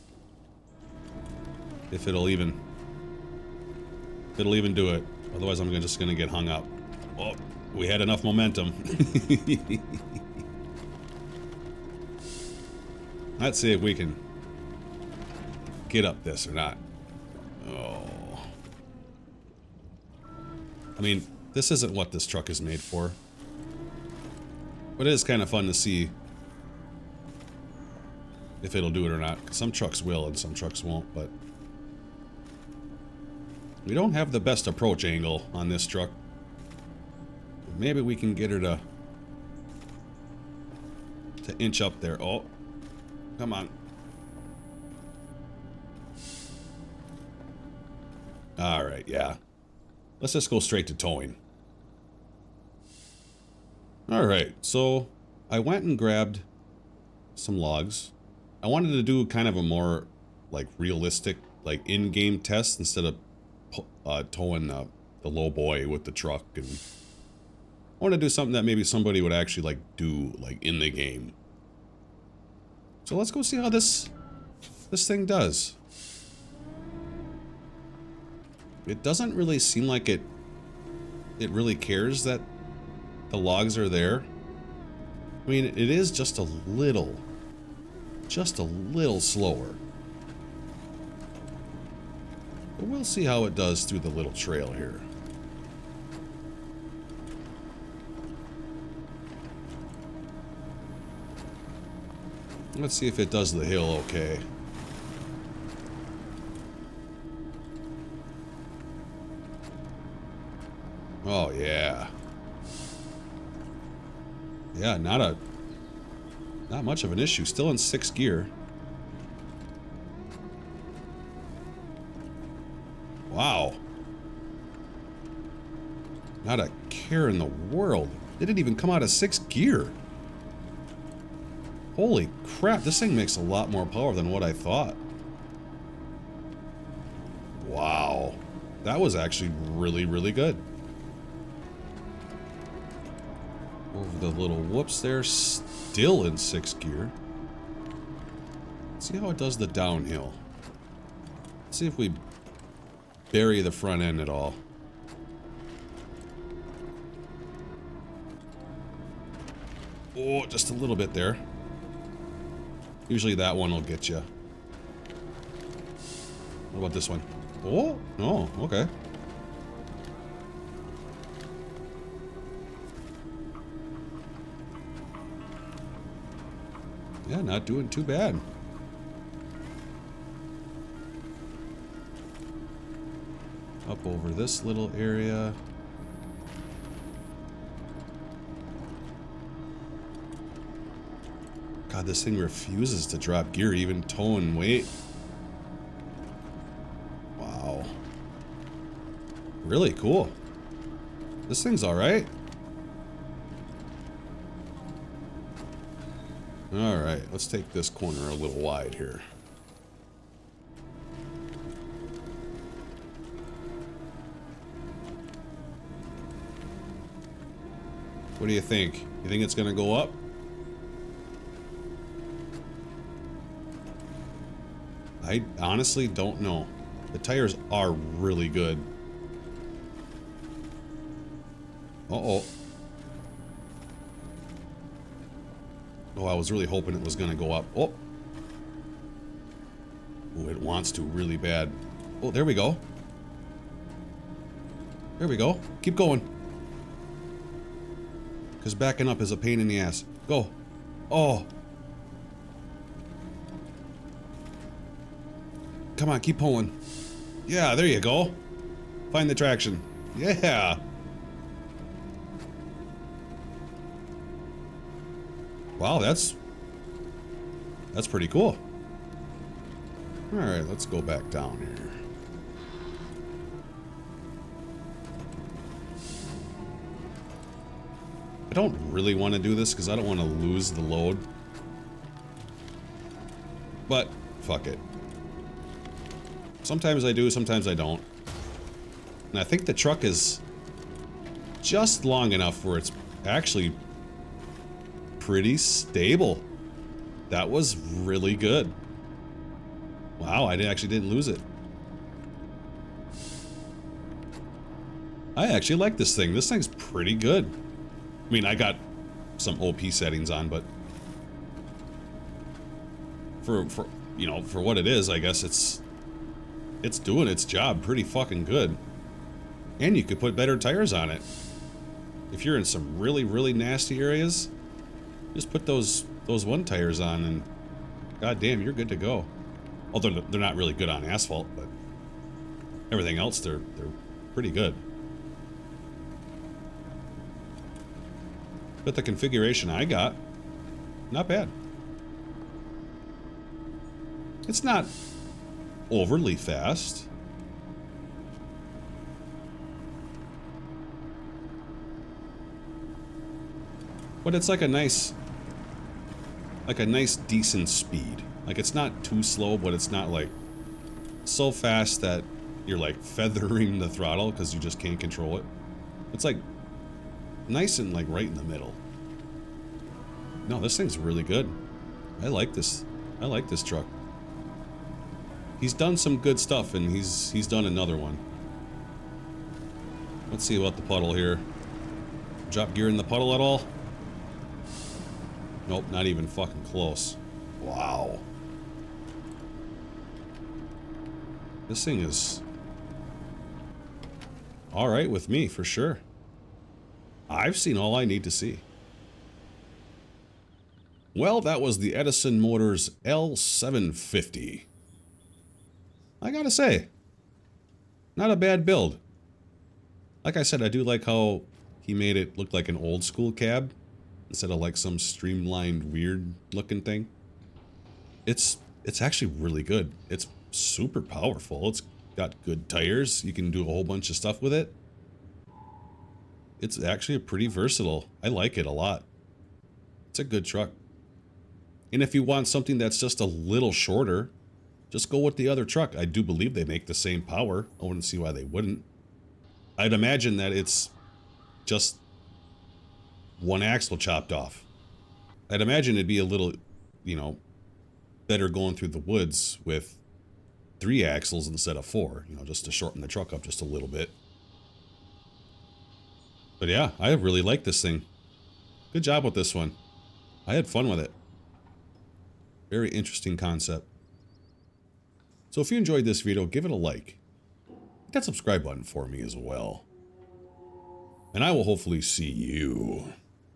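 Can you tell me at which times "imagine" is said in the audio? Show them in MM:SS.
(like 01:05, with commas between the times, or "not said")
07:19, 07:25.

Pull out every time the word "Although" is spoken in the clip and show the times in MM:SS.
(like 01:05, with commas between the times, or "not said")
05:29.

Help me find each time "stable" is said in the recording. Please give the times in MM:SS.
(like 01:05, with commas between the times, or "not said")
04:55.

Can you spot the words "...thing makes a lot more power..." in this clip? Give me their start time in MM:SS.
02:12.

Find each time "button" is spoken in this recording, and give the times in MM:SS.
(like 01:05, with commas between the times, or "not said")
07:48.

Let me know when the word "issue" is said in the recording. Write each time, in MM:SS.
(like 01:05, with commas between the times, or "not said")
01:57.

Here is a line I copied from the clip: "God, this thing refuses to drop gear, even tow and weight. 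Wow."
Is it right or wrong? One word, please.
right.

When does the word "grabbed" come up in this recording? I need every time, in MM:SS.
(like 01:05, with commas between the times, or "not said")
00:55.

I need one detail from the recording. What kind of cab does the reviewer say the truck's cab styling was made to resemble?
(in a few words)
old school cab.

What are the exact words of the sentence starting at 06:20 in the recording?
Let's see about the puddle here.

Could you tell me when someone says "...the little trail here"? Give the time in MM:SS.
01:33.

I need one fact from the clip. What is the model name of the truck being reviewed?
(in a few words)
Edison Motors L750.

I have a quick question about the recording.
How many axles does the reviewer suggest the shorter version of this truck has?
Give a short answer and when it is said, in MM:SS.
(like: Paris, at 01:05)
3, at 07:30.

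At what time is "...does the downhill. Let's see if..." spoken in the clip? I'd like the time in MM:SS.
02:29.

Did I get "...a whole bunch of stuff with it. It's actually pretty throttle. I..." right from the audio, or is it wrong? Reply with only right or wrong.
wrong.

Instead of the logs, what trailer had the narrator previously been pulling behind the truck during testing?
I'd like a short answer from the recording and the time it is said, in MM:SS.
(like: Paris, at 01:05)
low boy, at 01:05.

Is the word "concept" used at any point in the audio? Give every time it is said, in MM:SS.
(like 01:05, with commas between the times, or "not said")
07:43.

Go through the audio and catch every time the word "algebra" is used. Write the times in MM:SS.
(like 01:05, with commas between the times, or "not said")
not said.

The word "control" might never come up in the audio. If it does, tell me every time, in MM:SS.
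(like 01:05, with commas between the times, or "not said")
06:04.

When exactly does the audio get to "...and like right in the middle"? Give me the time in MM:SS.
06:07.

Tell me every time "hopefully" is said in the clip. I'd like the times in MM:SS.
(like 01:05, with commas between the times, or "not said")
07:51.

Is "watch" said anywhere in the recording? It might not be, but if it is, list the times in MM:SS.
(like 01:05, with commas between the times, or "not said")
not said.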